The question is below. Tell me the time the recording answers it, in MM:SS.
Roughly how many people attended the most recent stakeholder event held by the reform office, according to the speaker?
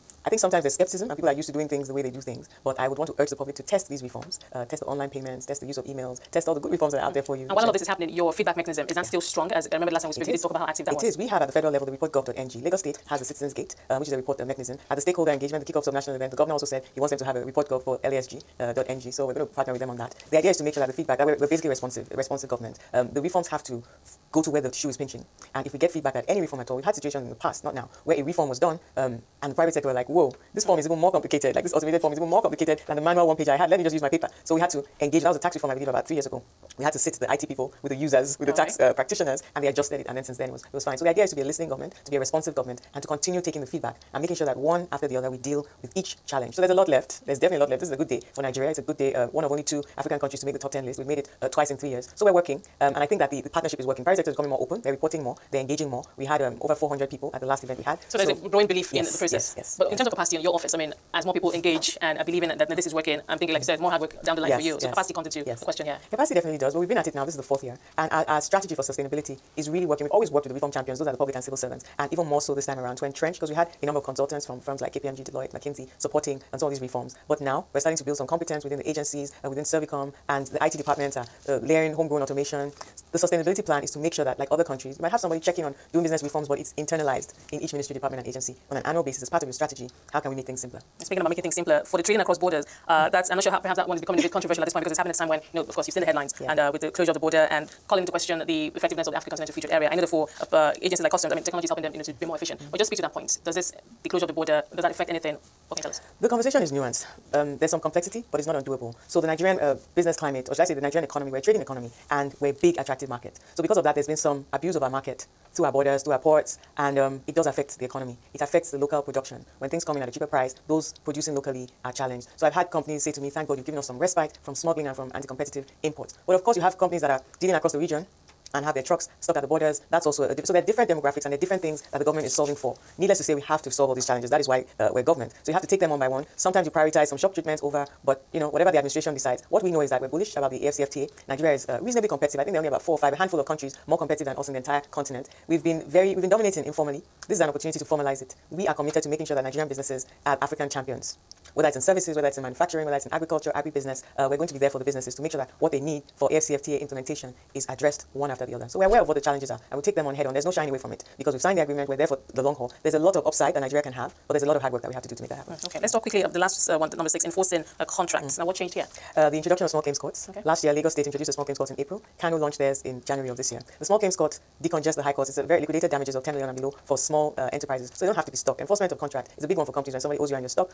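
00:56.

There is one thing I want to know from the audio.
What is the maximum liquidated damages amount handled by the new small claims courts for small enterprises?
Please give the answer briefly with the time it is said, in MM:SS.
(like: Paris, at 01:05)
10 million, at 02:56.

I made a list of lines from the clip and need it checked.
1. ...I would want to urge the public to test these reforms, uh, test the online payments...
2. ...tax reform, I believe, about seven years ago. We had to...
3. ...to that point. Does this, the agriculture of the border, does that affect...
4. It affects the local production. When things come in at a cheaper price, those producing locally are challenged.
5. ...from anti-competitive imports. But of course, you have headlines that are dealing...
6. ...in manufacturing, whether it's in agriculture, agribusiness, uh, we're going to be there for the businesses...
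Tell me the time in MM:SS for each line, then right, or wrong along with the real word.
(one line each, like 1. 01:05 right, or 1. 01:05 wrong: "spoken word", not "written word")
1. 00:02 right
2. 00:35 wrong: "three", not "seven"
3. 01:42 wrong: "closure", not "agriculture"
4. 01:58 right
5. 02:04 wrong: "companies", not "headlines"
6. 02:32 right.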